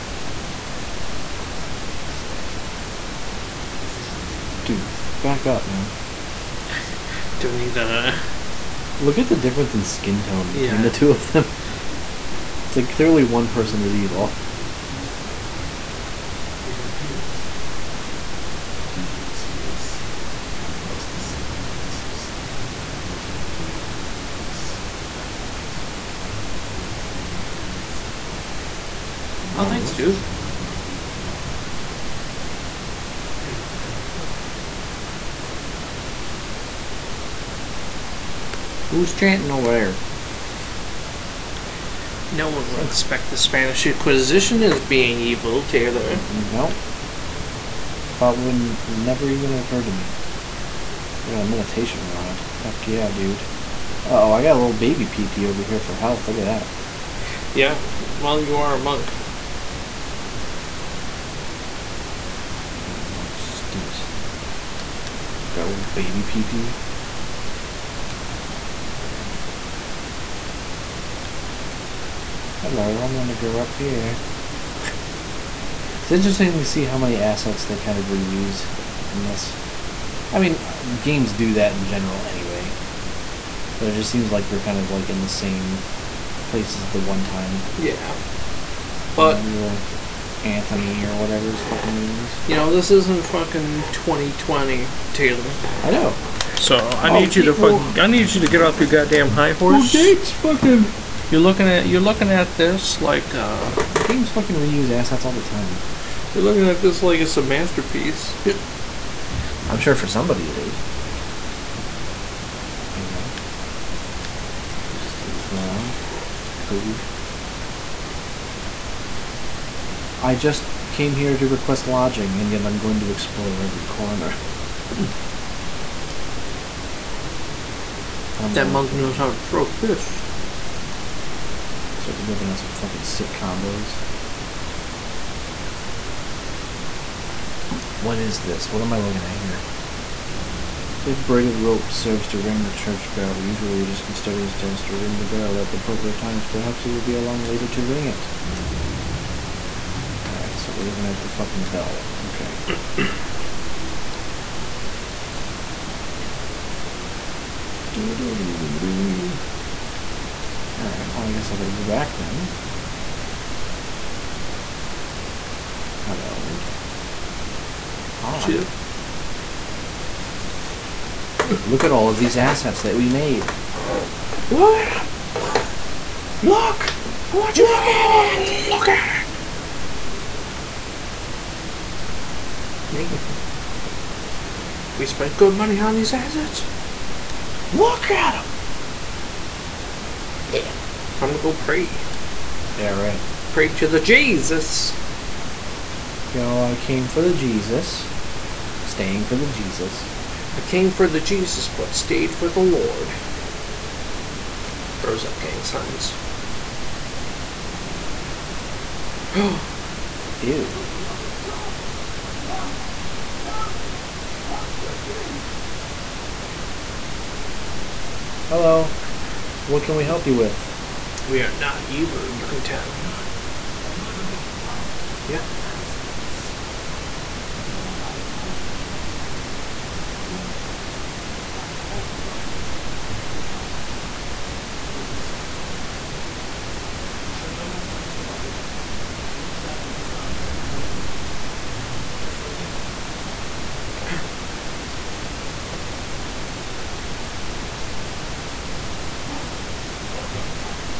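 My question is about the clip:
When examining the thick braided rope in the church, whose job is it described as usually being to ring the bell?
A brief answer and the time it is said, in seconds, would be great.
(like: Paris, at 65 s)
custodian, at 144 s.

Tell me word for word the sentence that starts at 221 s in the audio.
We are not evil, you can tell.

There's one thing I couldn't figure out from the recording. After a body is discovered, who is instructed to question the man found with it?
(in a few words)
Teresa.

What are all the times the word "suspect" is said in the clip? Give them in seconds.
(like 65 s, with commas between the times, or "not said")
235 s.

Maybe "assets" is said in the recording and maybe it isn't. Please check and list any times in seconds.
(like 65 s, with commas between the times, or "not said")
77 s, 104 s, 172 s, 186 s.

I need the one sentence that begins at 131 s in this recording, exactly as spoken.
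He starts whipping out some fucking sick combos.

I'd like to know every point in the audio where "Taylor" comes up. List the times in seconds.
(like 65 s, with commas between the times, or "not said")
45 s, 95 s.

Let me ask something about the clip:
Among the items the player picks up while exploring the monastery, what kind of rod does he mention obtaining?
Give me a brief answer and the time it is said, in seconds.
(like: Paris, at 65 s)
meditation rod, at 51 s.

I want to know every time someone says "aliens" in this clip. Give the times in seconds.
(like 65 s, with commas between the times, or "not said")
25 s.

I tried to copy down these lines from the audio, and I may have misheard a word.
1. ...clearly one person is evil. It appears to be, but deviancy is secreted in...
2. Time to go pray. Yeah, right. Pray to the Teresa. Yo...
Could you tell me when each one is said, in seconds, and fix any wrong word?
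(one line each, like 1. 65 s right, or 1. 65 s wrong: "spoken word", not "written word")
1. 12 s right
2. 191 s wrong: "Jesus", not "Teresa".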